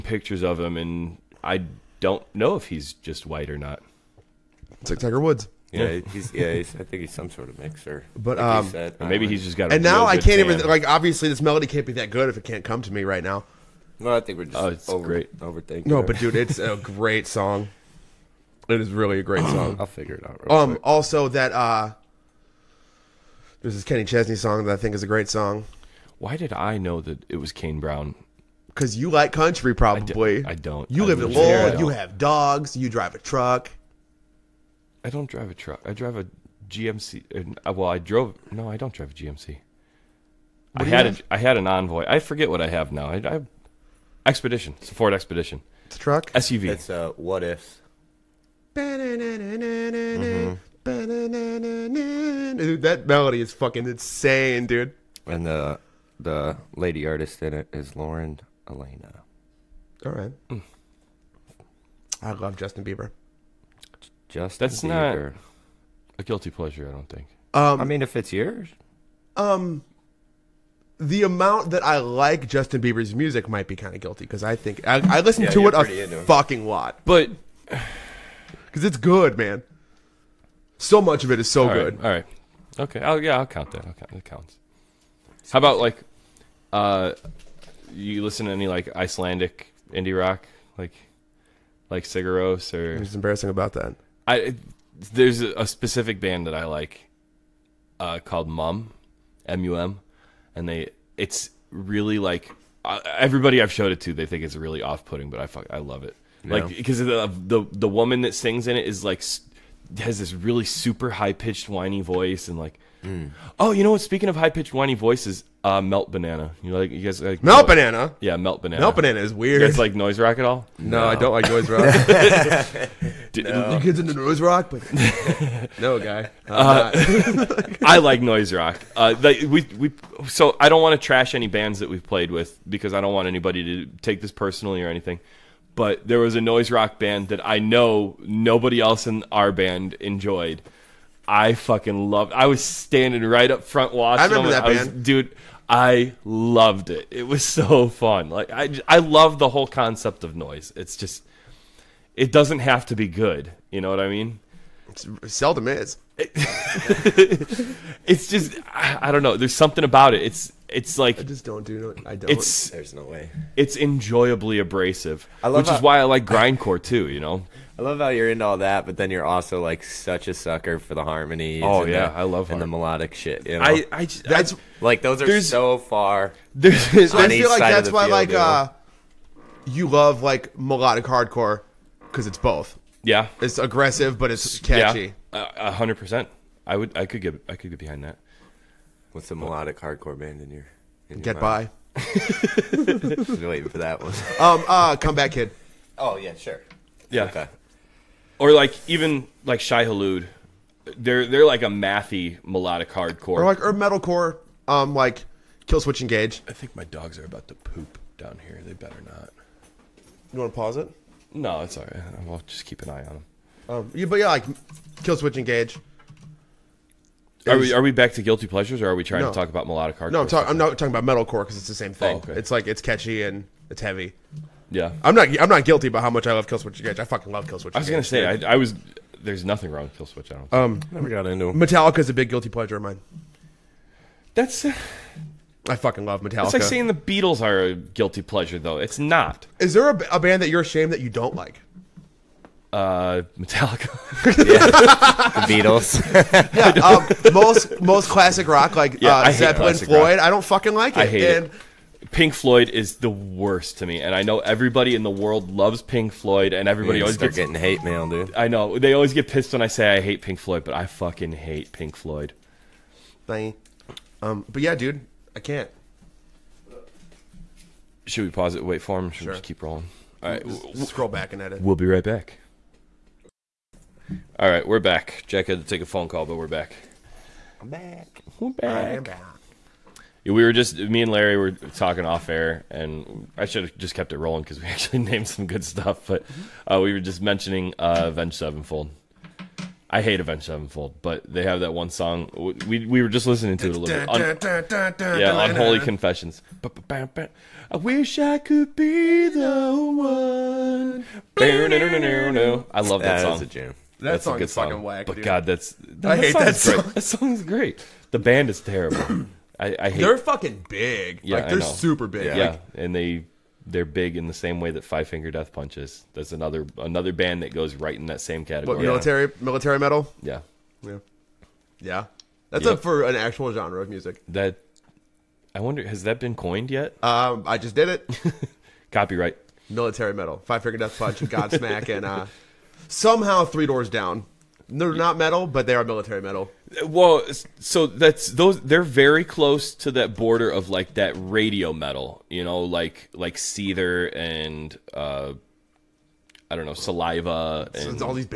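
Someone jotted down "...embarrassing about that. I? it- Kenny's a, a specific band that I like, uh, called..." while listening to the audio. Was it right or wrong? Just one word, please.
wrong.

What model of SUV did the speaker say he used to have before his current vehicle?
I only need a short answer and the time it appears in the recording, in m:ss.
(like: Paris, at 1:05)
Envoy, at 0:41.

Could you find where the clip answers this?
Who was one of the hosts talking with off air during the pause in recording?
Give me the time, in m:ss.
4:41.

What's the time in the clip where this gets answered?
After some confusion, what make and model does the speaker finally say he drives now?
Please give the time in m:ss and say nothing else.
0:44.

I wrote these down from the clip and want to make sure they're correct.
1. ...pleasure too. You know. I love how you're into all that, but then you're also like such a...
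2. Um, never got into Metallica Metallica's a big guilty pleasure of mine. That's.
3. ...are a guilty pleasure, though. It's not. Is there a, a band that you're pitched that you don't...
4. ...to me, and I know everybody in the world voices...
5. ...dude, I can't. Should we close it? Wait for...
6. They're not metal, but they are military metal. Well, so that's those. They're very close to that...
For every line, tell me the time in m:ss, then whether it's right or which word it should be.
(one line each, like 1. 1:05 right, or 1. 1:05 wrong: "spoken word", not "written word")
1. 2:46 wrong: "grindcore", not "pleasure"
2. 3:50 right
3. 3:57 wrong: "ashamed", not "pitched"
4. 4:13 wrong: "loves", not "voices"
5. 4:24 wrong: "pause", not "close"
6. 5:34 right.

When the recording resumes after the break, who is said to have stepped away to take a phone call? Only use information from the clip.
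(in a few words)
Jack.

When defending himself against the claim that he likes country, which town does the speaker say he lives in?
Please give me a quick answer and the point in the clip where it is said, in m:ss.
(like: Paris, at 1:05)
Lowell, at 0:31.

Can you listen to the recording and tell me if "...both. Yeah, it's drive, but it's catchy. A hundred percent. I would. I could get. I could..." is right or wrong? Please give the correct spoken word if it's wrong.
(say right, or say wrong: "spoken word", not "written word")
wrong: "aggressive", not "drive".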